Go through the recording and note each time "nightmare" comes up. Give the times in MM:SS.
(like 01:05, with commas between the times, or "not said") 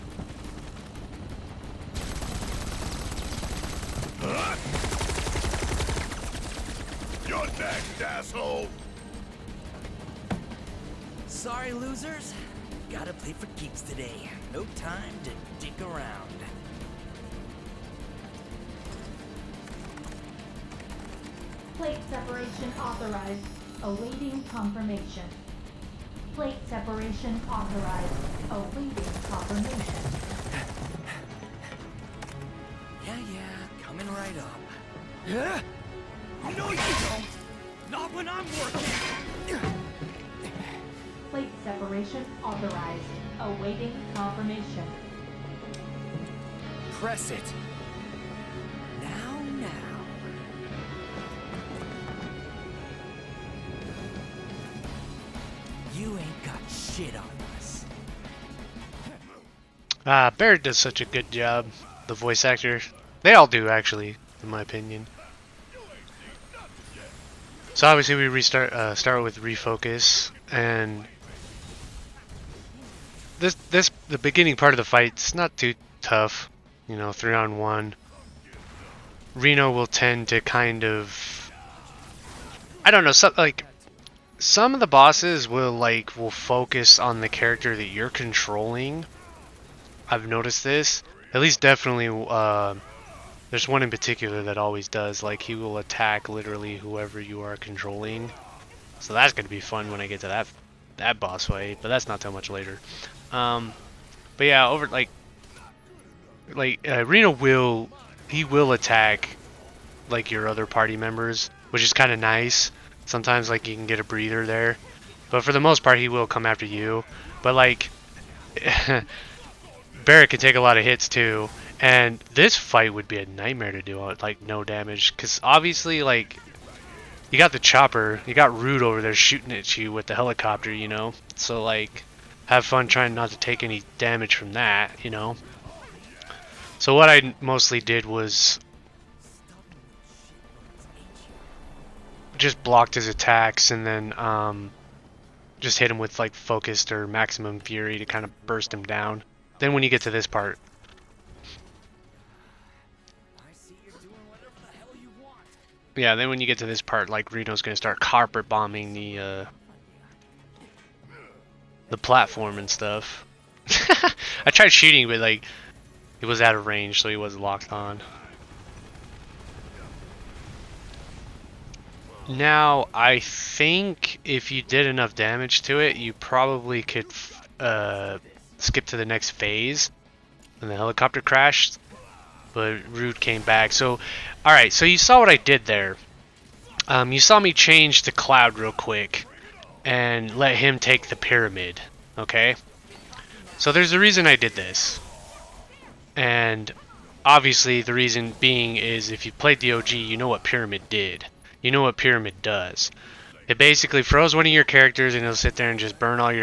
02:03.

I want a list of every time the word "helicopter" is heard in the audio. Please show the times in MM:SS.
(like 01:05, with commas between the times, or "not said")
02:10, 03:00.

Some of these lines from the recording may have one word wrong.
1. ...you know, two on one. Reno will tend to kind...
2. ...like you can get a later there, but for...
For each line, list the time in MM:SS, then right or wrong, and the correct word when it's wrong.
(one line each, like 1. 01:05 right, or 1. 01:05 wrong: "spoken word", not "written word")
1. 01:16 wrong: "three", not "two"
2. 01:53 wrong: "breather", not "later".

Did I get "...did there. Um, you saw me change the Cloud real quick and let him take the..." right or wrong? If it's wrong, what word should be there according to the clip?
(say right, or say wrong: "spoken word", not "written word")
right.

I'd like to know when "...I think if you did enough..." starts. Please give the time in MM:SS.
02:52.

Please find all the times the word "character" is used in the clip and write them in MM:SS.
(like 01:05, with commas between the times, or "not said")
01:27, 03:24.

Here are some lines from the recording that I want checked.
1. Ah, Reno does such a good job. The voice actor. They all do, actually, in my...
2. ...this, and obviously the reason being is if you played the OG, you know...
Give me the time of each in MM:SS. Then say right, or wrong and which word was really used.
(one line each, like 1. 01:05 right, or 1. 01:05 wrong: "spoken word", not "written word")
1. 01:00 wrong: "Barret", not "Reno"
2. 03:14 right.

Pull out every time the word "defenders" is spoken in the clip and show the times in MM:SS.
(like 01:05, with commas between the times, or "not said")
not said.